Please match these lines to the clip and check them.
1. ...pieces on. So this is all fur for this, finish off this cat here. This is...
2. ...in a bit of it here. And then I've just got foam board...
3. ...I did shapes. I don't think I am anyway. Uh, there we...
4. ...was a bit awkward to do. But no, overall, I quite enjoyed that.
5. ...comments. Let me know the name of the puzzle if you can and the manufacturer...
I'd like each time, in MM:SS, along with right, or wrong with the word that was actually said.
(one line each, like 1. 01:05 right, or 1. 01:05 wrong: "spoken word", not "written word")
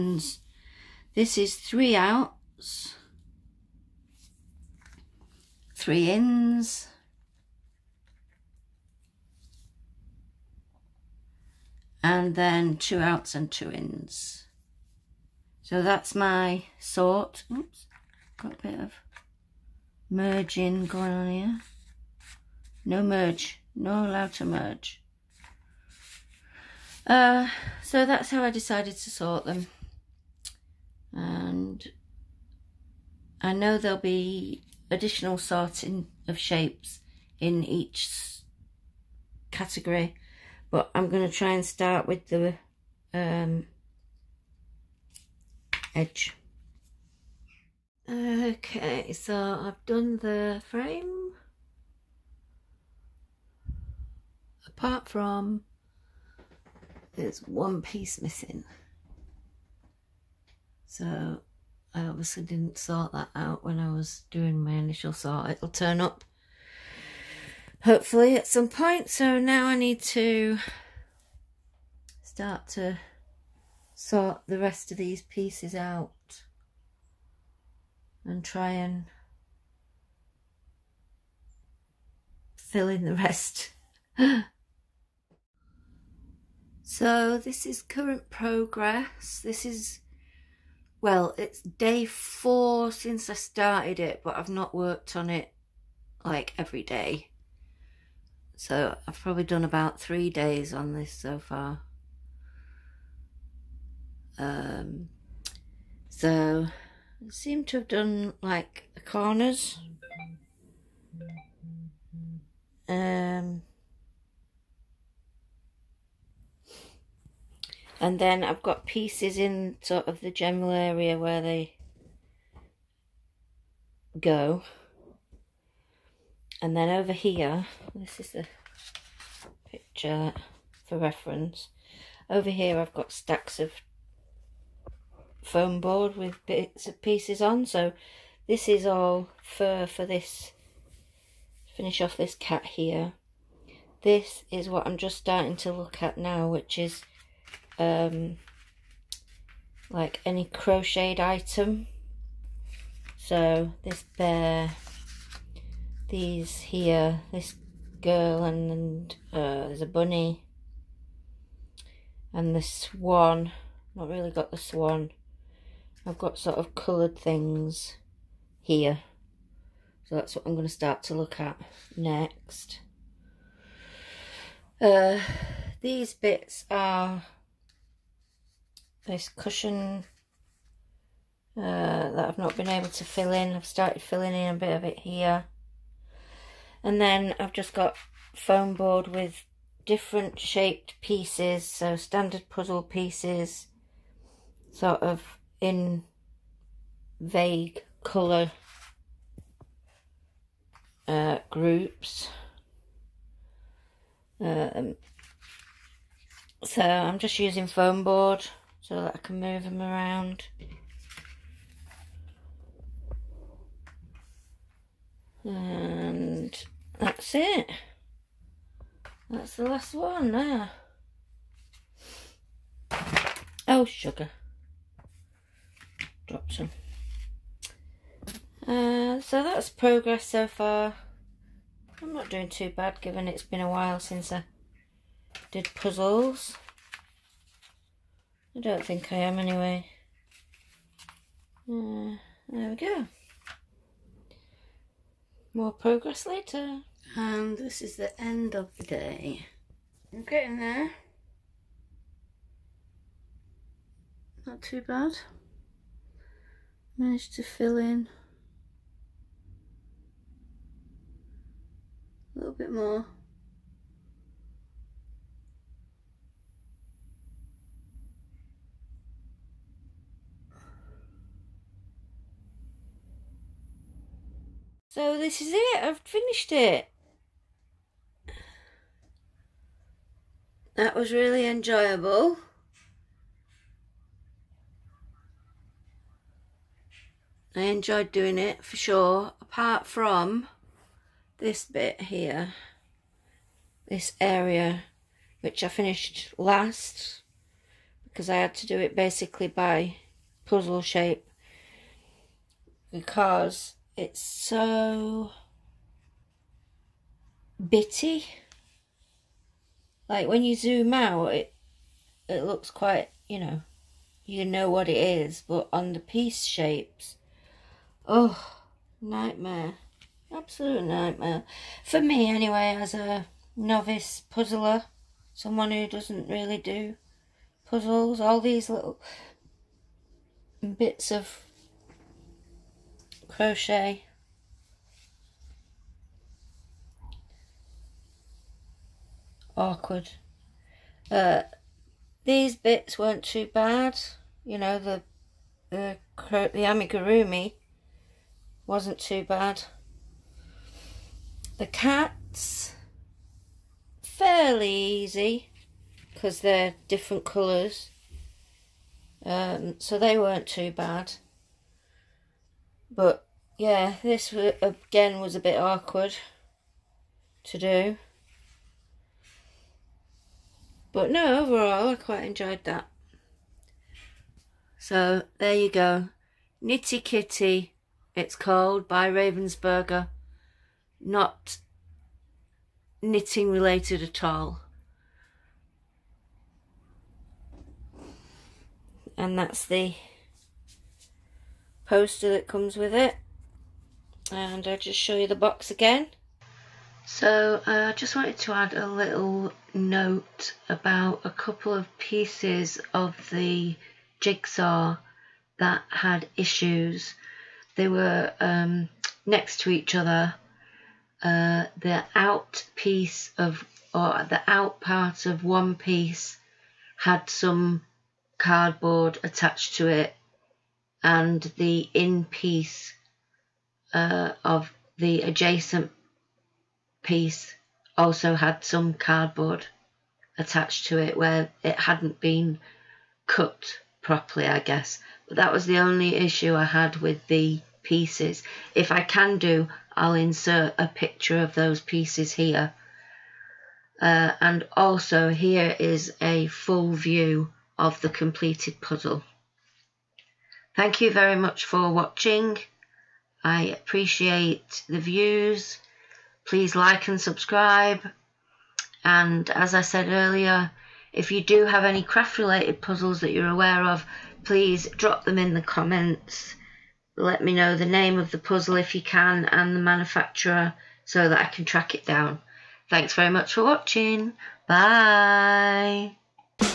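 1. 02:17 right
2. 03:04 right
3. 03:54 wrong: "puzzles", not "shapes"
4. 06:05 right
5. 07:45 right.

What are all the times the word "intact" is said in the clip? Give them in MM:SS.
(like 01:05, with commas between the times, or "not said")
not said.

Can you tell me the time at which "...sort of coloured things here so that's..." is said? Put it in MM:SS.
02:46.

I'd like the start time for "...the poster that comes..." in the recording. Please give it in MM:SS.
06:29.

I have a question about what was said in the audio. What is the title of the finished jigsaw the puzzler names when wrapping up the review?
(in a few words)
Knitty Kitty, It's Cold.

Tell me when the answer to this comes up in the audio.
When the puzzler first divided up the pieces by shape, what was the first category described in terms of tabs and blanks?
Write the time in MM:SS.
00:01.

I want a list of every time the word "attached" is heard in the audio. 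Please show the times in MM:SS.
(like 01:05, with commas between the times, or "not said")
06:59, 07:10.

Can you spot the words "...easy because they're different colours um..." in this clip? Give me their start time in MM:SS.
05:54.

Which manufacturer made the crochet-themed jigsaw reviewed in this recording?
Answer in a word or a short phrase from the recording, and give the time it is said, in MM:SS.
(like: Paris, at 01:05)
Ravensburger, at 06:19.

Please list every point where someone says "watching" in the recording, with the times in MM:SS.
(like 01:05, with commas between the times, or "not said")
07:31, 07:53.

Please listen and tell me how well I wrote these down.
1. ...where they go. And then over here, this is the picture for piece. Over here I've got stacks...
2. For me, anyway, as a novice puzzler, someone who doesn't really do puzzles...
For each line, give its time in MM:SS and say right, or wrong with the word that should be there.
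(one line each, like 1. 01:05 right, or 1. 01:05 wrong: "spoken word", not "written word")
1. 02:01 wrong: "reference", not "piece"
2. 05:21 right.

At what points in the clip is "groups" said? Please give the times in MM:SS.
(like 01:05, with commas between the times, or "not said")
03:21.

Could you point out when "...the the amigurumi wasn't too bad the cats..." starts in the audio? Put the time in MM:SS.
05:45.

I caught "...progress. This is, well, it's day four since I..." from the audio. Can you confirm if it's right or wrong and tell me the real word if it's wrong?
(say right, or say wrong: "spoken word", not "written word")
right.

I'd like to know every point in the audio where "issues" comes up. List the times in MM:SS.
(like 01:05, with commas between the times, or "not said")
06:46, 07:16.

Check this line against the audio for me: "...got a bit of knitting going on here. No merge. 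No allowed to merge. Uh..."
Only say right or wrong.
wrong.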